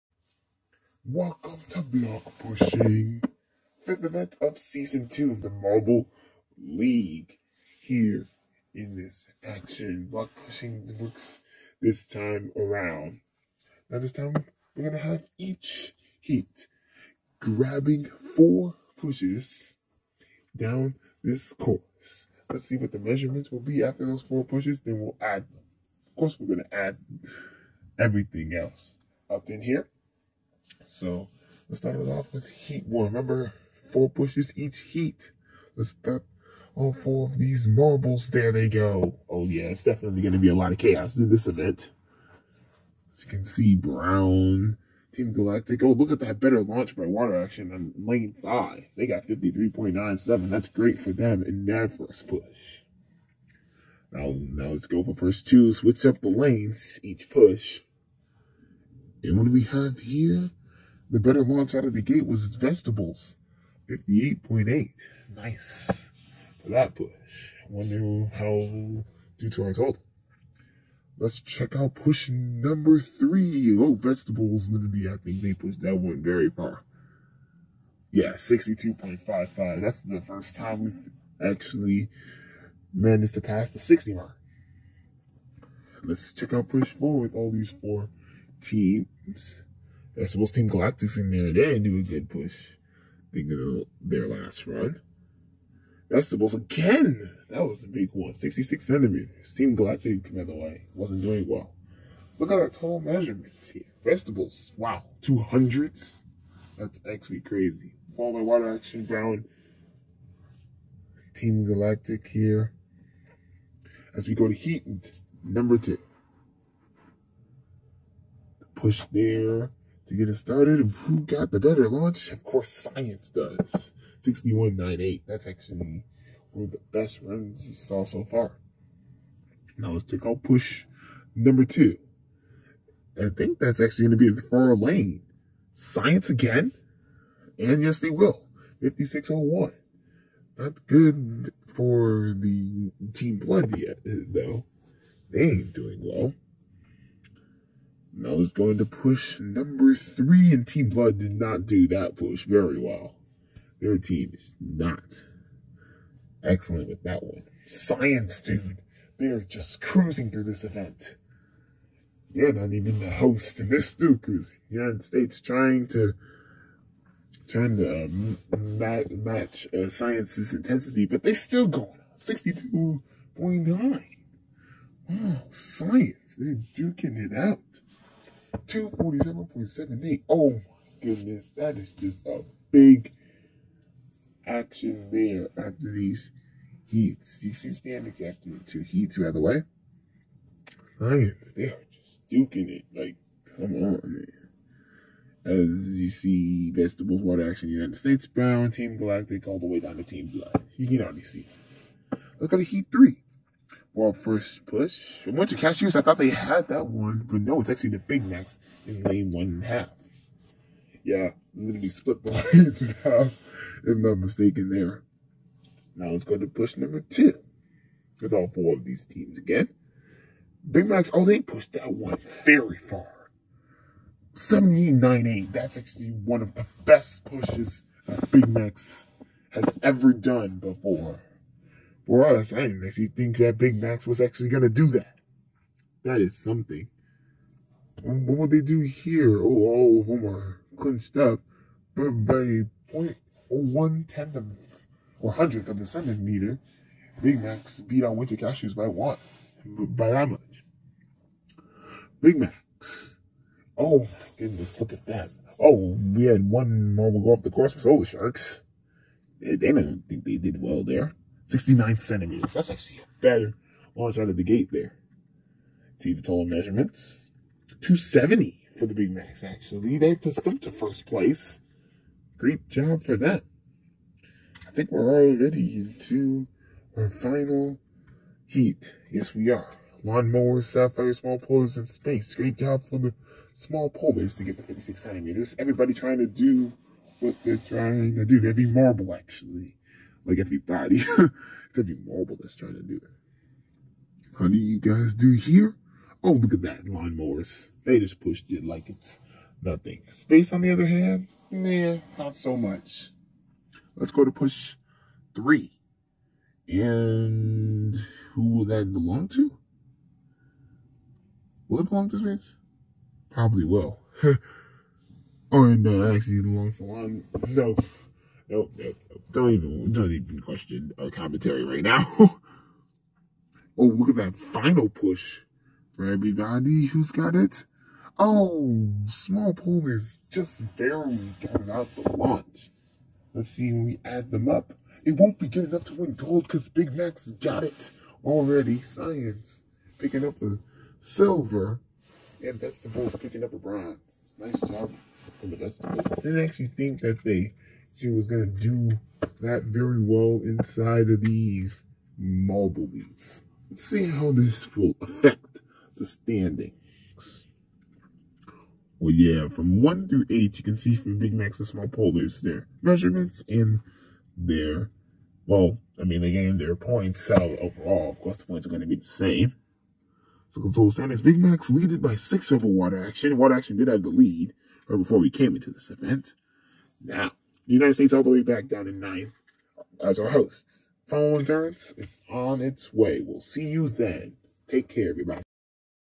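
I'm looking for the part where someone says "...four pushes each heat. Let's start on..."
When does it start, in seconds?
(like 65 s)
33 s.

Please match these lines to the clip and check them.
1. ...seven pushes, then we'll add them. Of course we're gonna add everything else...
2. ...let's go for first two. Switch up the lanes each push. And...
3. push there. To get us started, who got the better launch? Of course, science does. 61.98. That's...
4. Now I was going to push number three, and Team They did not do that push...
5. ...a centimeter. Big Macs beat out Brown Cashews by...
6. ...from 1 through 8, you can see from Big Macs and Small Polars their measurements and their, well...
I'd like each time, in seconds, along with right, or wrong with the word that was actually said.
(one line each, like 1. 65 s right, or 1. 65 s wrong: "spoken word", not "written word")
1. 24 s wrong: "four", not "seven"
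2. 54 s right
3. 118 s right
4. 148 s wrong: "Blood", not "They"
5. 245 s wrong: "Winter", not "Brown"
6. 359 s right.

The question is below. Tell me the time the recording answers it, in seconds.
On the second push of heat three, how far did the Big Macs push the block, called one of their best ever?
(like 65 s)
224 s.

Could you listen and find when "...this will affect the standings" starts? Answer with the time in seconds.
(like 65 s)
354 s.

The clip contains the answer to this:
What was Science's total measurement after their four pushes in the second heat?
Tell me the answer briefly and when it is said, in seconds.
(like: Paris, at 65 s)
247.78, at 178 s.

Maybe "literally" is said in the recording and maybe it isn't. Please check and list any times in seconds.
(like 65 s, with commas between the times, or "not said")
74 s, 211 s.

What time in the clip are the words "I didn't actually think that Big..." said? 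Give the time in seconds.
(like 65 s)
232 s.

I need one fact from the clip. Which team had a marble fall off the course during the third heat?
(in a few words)
Solar Sharks.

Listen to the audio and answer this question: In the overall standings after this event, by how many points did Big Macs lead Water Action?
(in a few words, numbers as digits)
6.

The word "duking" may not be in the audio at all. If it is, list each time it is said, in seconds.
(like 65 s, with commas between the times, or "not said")
176 s, 192 s.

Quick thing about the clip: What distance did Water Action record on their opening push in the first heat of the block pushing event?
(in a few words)
53.97.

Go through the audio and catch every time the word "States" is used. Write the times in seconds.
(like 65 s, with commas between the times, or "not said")
165 s, 197 s, 377 s.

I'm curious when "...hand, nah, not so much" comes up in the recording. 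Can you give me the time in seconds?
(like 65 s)
300 s.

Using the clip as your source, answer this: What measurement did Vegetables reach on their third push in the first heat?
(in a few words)
62.55.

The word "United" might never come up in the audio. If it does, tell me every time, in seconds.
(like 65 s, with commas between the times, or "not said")
164 s, 197 s, 377 s.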